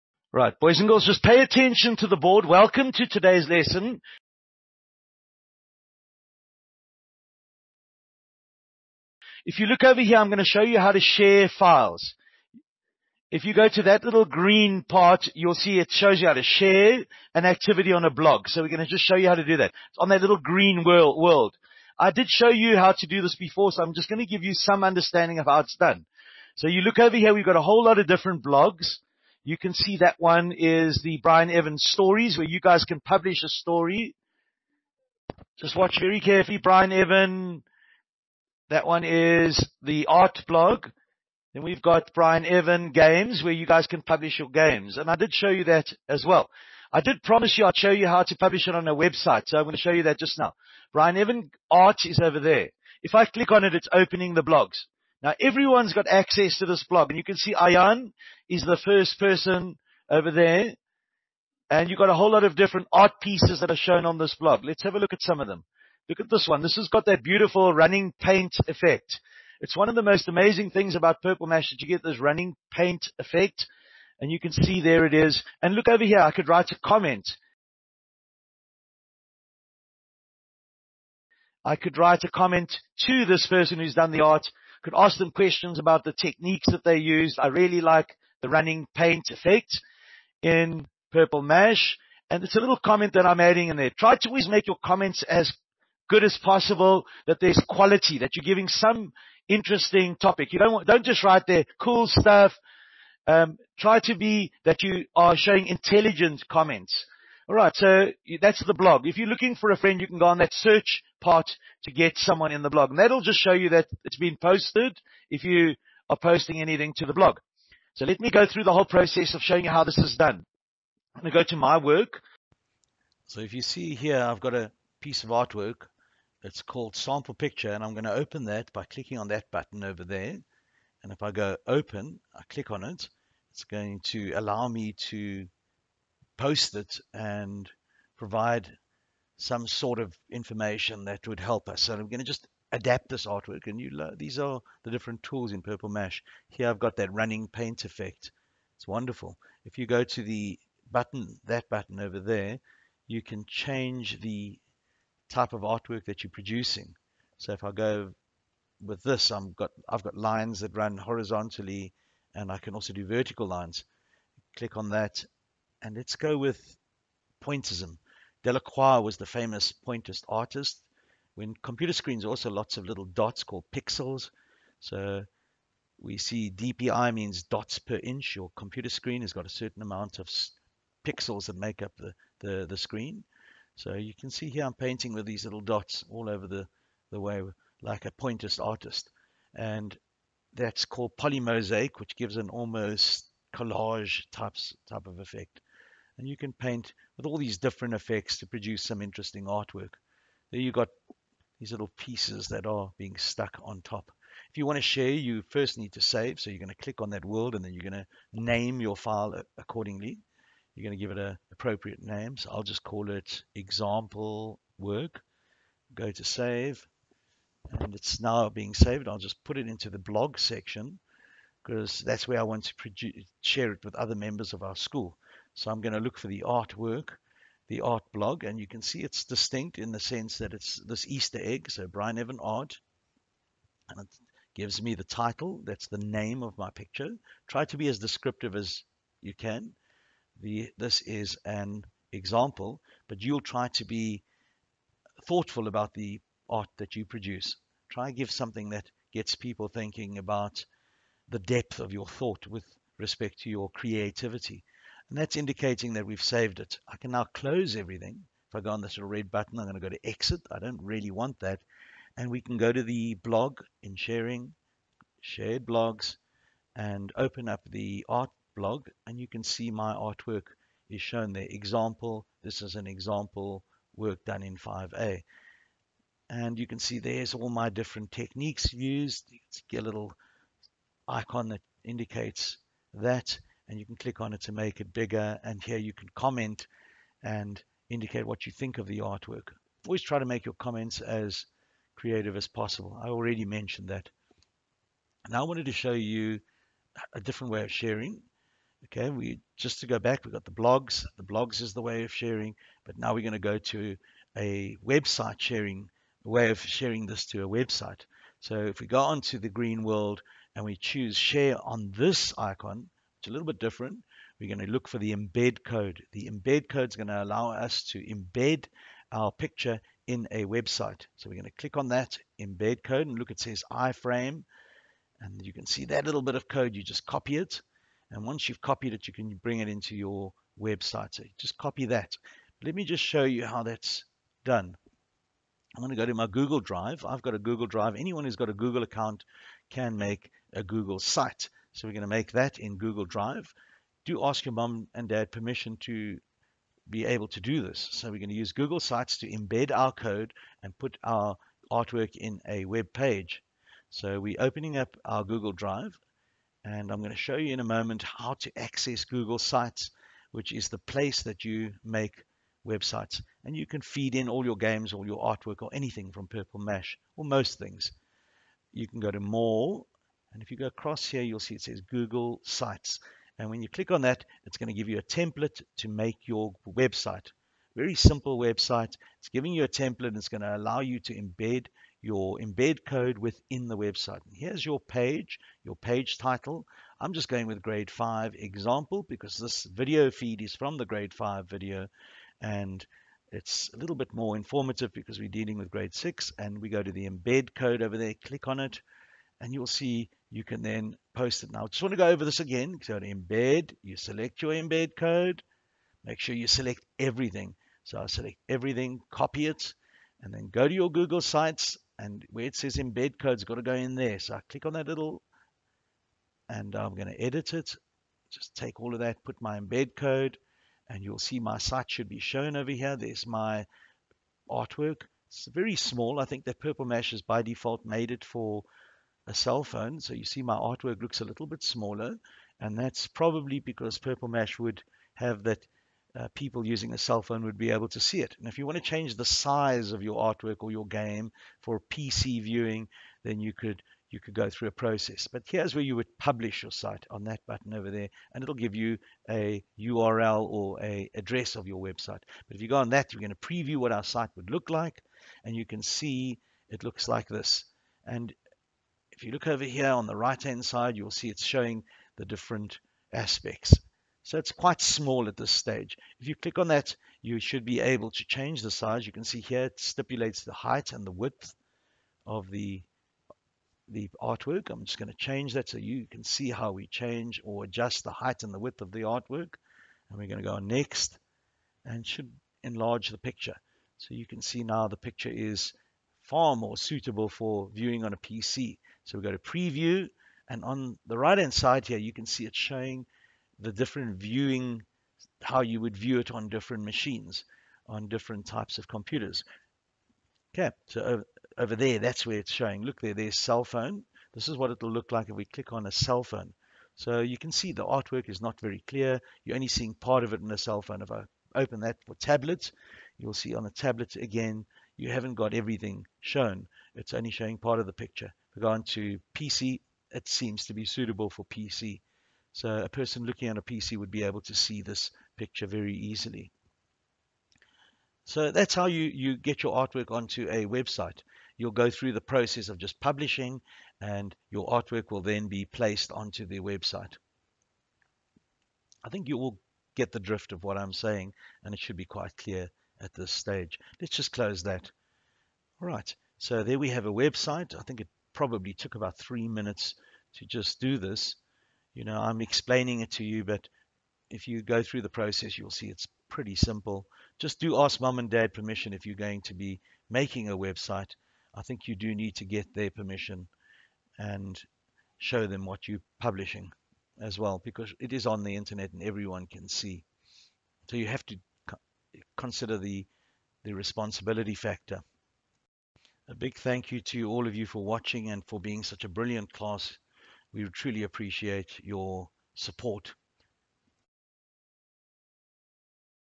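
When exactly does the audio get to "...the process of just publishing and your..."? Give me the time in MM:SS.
08:52.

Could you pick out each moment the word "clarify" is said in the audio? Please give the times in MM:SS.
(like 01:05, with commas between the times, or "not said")
not said.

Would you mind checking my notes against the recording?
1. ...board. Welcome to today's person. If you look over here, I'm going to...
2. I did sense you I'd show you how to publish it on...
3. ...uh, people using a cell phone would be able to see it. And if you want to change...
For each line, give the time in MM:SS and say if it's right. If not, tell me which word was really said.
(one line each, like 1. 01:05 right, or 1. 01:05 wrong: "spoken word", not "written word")
1. 00:02 wrong: "lesson", not "person"
2. 00:46 wrong: "promise", not "sense"
3. 07:16 right.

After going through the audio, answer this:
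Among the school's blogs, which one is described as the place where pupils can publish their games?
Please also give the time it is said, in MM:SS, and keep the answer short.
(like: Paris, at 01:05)
Bryneven games, at 00:42.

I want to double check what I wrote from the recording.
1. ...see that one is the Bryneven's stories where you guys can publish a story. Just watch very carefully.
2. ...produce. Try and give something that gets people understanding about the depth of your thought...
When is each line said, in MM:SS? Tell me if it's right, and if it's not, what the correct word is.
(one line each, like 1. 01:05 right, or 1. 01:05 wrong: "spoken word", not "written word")
1. 00:29 right
2. 04:07 wrong: "thinking", not "understanding".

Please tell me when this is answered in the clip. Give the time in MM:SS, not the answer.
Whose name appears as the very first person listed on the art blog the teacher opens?
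00:57.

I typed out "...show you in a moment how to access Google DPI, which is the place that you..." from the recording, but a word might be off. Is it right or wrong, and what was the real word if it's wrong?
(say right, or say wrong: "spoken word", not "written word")
wrong: "Sites", not "DPI".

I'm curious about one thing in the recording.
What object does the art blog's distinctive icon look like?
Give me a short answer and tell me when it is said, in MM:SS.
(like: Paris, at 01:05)
Easter egg, at 03:51.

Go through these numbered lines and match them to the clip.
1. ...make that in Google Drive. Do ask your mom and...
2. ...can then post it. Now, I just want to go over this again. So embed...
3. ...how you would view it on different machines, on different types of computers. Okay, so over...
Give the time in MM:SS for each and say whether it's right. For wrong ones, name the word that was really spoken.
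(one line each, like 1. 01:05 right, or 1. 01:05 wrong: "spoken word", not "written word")
1. 05:42 right
2. 06:40 right
3. 08:15 right.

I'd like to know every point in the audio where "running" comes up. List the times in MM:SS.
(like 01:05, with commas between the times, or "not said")
01:07, 01:12, 01:28, 02:27.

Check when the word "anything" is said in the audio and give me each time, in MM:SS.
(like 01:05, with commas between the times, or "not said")
01:56, 06:05.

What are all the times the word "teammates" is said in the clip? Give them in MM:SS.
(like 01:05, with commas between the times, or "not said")
not said.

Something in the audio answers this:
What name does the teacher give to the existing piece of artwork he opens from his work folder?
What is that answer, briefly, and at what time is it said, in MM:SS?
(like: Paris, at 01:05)
sample picture, at 02:06.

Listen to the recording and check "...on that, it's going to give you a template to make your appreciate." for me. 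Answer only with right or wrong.
wrong.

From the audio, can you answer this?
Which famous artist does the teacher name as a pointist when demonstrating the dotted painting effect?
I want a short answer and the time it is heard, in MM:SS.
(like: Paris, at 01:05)
Delacroix, at 02:48.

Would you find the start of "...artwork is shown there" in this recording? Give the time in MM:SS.
04:29.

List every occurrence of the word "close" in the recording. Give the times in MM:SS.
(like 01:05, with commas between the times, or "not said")
04:17, 09:04.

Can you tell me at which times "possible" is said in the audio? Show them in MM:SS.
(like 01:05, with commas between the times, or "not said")
01:36, 04:52.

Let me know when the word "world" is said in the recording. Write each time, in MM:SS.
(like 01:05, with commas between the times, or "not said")
00:20, 03:27, 05:09.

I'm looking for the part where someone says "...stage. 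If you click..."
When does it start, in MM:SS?
07:45.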